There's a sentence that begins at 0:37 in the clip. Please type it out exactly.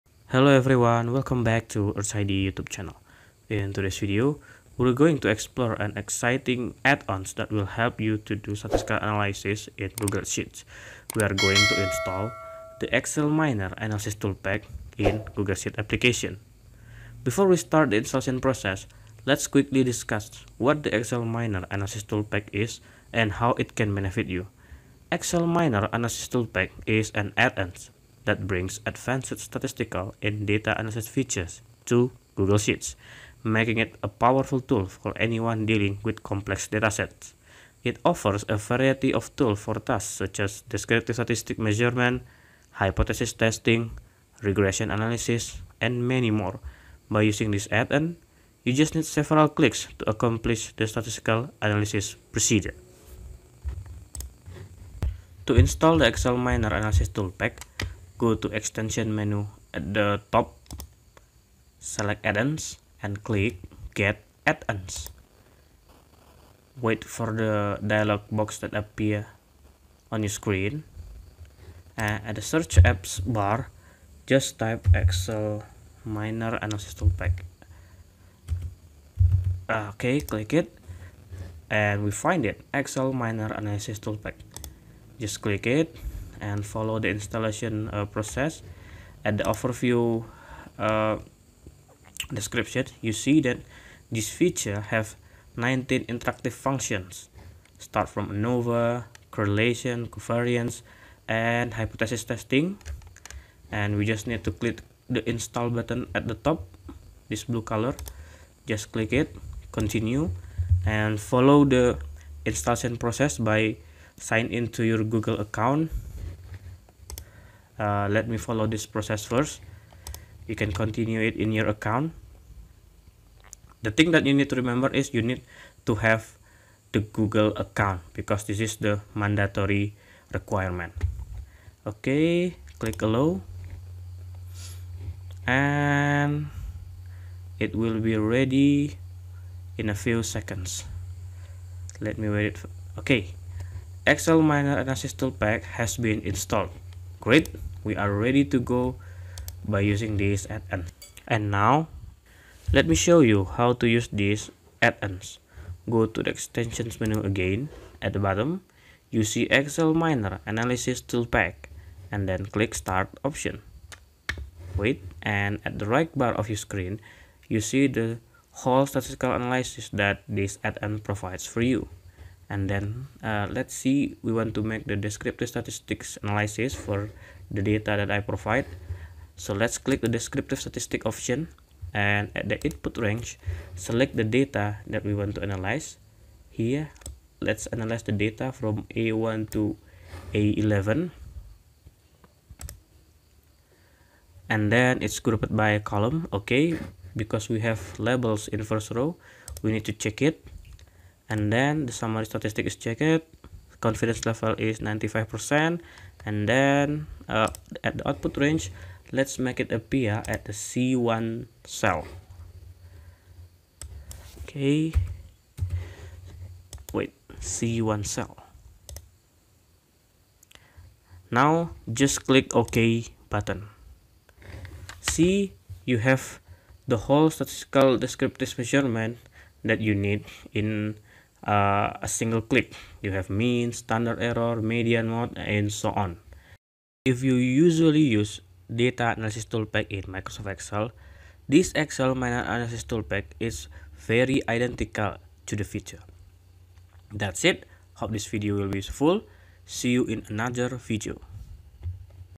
It offers a variety of tools for tasks such as descriptive statistic measurement, hypothesis testing, regression analysis, and many more.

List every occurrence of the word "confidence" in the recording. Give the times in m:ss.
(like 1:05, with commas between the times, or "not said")
3:23.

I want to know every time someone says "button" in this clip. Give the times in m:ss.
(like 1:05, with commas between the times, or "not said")
1:45, 3:43.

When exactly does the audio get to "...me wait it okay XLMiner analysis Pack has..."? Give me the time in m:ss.
2:22.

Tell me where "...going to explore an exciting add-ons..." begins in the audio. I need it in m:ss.
0:04.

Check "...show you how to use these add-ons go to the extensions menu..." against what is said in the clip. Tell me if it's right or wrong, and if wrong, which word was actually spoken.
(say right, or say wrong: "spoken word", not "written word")
right.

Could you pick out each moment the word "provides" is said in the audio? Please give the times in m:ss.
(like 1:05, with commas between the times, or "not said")
2:50, 2:58.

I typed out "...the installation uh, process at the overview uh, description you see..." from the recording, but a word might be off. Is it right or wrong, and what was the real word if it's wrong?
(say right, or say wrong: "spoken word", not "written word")
right.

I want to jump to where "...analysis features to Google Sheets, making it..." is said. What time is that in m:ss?
0:30.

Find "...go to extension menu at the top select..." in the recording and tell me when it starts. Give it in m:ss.
0:58.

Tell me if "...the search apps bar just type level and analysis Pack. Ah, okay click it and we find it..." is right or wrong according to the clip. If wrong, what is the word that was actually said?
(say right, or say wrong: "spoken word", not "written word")
wrong: "excel", not "level".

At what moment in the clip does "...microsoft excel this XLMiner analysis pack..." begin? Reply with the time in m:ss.
4:00.